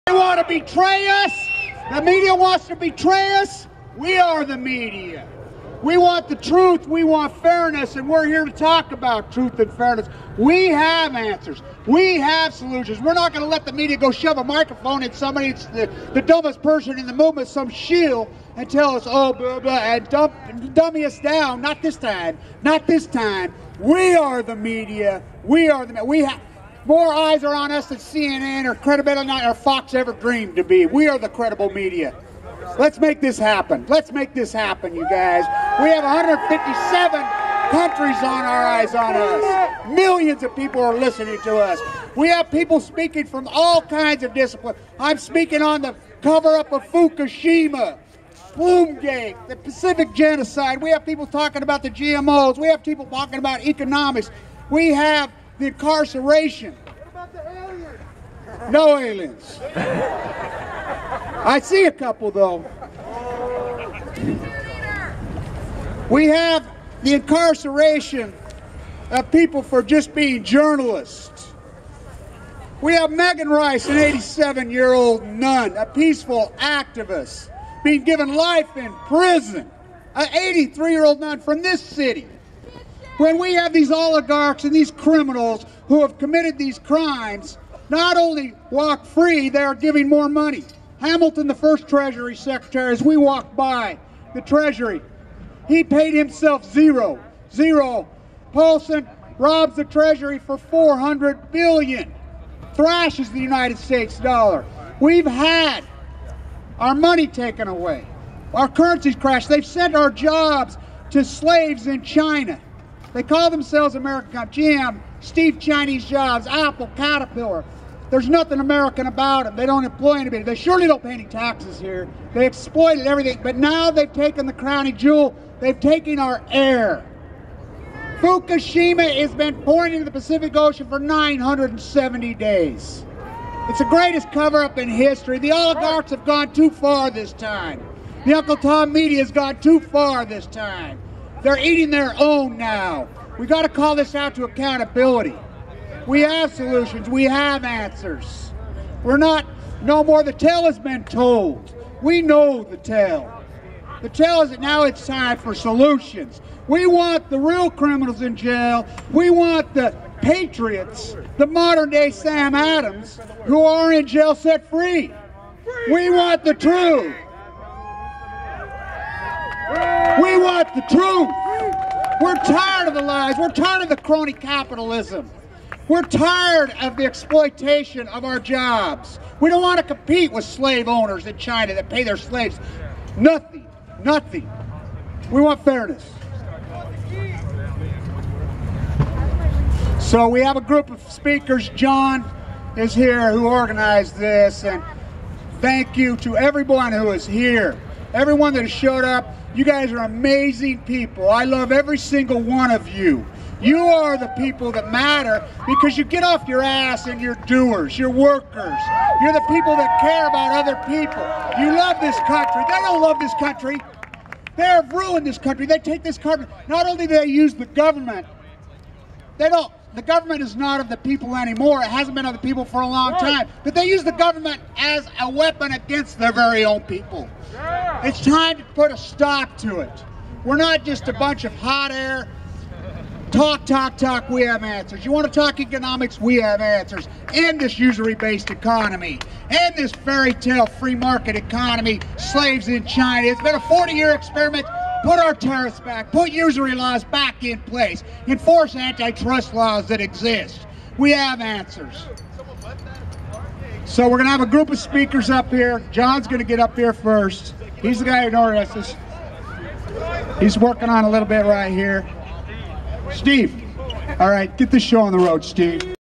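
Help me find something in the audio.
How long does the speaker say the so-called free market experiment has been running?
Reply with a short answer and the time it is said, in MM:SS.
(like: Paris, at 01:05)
40 years, at 04:03.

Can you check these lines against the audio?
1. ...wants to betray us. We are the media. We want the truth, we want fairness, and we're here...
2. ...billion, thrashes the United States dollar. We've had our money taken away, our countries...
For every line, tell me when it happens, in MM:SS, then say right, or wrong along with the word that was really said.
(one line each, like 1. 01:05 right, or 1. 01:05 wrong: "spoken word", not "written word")
1. 00:02 right
2. 01:41 wrong: "currencies", not "countries".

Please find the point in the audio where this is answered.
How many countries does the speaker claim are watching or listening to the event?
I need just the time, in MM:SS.
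00:36.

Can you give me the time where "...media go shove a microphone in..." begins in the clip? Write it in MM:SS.
00:13.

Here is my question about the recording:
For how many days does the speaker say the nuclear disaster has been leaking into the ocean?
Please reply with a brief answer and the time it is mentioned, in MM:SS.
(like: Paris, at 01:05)
970, at 02:10.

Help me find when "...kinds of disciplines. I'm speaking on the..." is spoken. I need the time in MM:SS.
00:43.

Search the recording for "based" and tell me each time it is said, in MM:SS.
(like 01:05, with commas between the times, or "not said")
03:58.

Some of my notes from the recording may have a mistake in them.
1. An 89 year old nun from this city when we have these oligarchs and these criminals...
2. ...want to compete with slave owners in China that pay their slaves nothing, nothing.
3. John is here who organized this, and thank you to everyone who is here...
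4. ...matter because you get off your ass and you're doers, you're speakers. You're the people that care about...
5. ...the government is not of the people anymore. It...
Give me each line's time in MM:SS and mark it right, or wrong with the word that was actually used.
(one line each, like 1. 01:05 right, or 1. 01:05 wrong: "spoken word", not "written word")
1. 01:20 wrong: "83", not "89"
2. 02:59 right
3. 03:11 right
4. 03:24 wrong: "workers", not "speakers"
5. 03:39 right.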